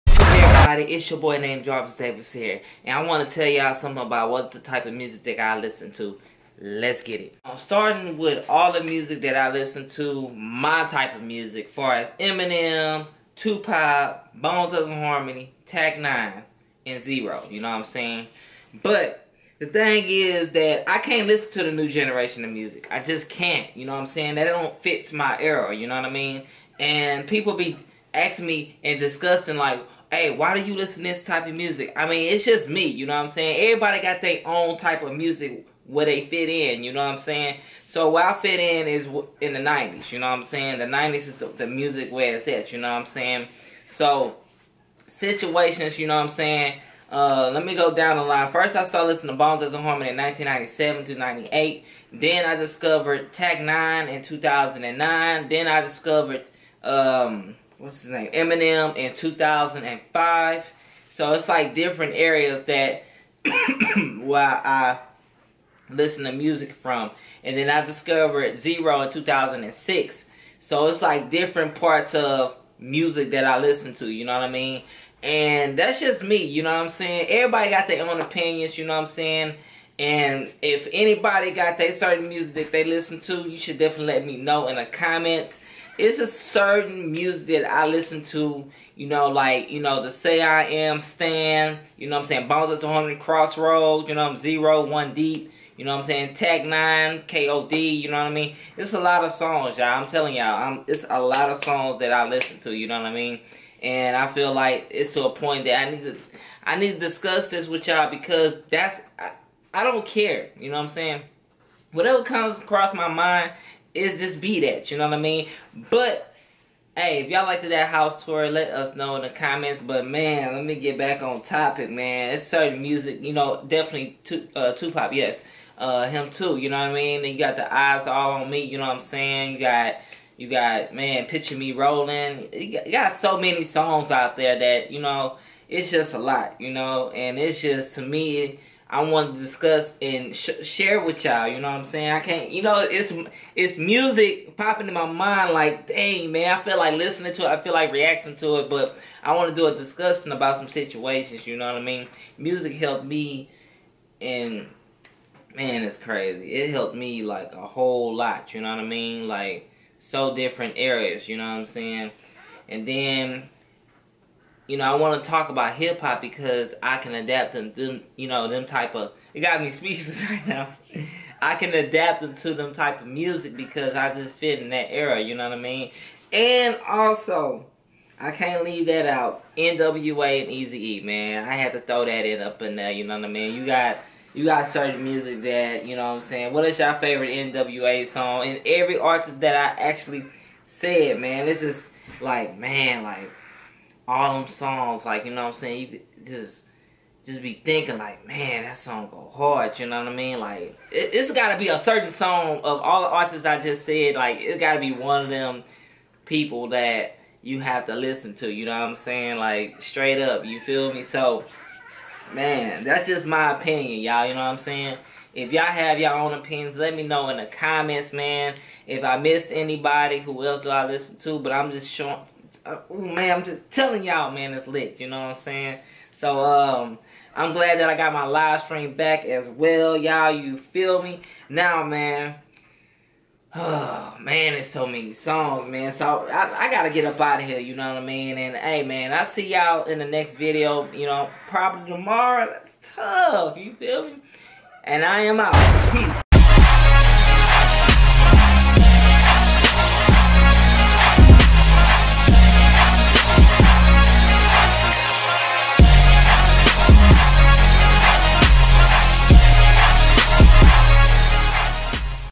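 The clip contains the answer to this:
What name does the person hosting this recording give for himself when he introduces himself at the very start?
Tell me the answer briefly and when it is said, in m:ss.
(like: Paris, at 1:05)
Jarvis Davis, at 0:01.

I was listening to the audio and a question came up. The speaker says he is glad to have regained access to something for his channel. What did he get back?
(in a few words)
live stream.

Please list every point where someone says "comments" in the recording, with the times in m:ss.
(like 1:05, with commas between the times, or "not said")
1:24, 1:59, 3:37.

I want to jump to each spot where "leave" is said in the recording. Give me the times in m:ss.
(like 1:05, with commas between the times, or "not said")
2:58.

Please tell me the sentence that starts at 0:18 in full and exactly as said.
But the thing is that I can't listen to the new generation of music.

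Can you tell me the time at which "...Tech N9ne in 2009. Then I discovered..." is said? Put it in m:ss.
0:53.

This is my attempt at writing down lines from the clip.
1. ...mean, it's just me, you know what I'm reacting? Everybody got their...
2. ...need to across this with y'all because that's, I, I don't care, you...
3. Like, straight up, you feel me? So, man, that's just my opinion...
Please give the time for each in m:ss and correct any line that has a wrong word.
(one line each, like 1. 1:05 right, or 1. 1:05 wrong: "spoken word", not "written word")
1. 0:32 wrong: "saying", not "reacting"
2. 1:46 wrong: "discuss", not "across"
3. 3:29 right.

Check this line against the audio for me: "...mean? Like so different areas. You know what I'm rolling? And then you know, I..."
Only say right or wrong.
wrong.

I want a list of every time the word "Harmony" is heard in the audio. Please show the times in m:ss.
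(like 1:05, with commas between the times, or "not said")
0:14, 0:49.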